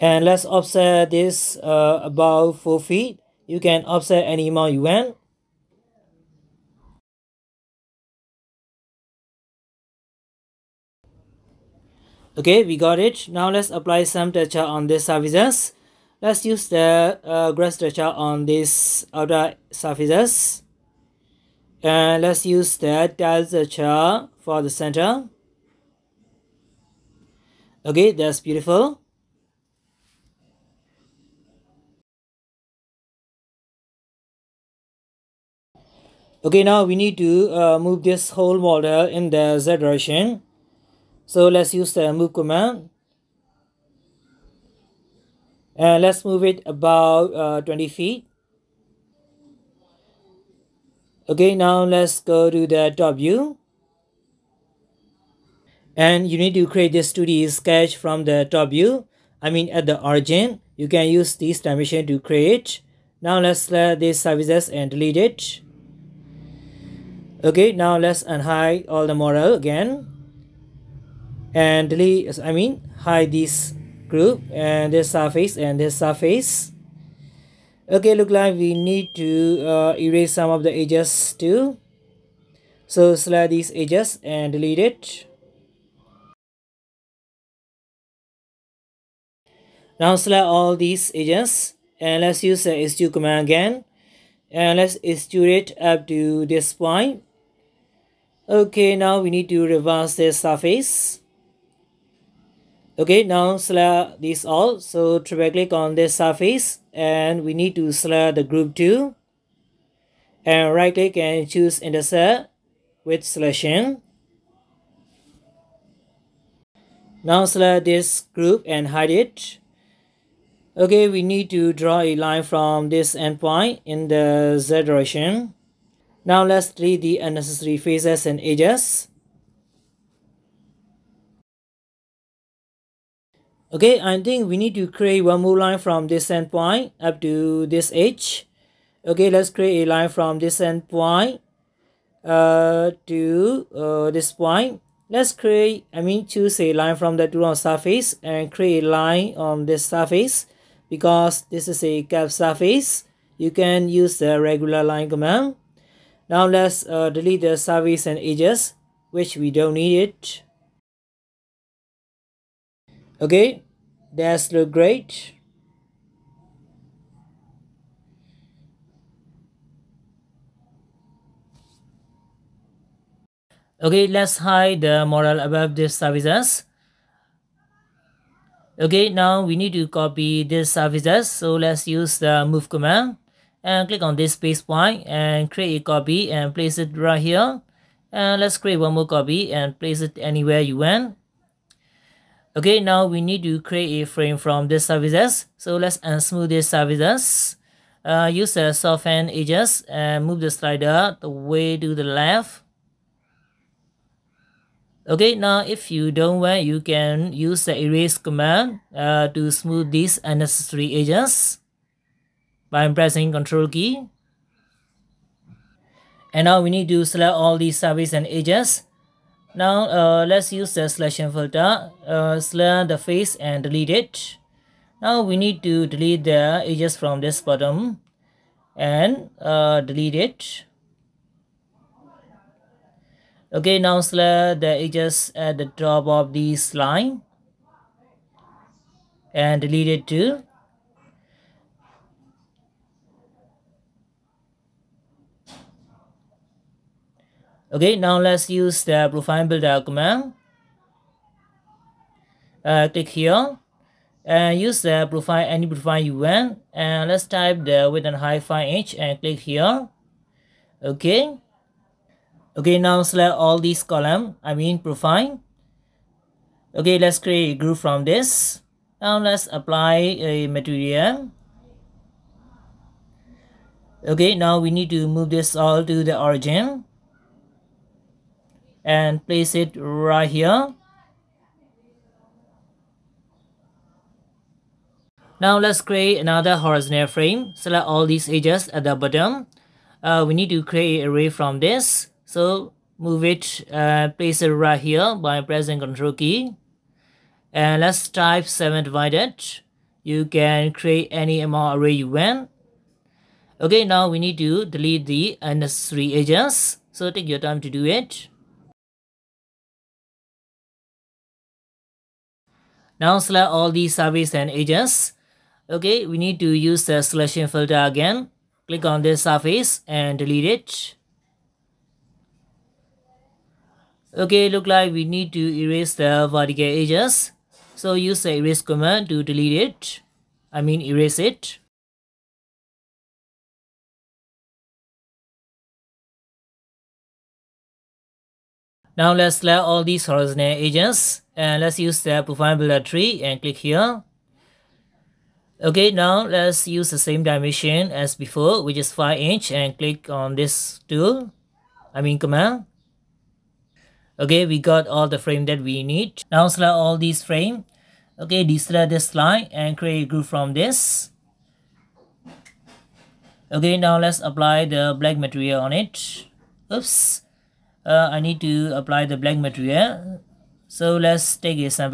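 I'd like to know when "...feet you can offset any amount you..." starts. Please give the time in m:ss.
0:02.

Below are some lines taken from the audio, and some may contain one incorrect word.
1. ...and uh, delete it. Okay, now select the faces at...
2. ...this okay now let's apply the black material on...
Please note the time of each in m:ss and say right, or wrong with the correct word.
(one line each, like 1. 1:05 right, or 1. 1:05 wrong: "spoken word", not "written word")
1. 3:48 wrong: "edges", not "faces"
2. 6:00 right.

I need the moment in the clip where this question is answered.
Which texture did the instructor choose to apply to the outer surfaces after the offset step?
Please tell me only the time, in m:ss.
0:17.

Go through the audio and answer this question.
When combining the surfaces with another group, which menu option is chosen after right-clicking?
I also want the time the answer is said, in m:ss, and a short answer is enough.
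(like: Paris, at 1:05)
intersect with selection, at 1:51.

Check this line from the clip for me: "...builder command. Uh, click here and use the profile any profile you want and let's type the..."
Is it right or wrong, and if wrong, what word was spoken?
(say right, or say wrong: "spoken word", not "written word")
right.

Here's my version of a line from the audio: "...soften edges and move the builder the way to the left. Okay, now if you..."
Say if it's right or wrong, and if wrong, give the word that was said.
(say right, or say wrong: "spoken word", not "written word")
wrong: "slider", not "builder".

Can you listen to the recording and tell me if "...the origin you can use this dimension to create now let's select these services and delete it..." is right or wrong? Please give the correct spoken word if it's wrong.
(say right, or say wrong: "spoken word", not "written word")
right.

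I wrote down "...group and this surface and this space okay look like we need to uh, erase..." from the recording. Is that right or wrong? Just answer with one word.
wrong.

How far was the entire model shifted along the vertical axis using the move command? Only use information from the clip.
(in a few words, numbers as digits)
20 feet.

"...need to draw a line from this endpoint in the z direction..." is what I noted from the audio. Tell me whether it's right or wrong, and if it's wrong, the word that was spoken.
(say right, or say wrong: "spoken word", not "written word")
right.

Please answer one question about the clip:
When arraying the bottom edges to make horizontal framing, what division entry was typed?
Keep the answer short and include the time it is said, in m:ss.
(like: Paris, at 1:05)
7 divided, at 4:58.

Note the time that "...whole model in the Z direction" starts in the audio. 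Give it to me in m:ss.
0:38.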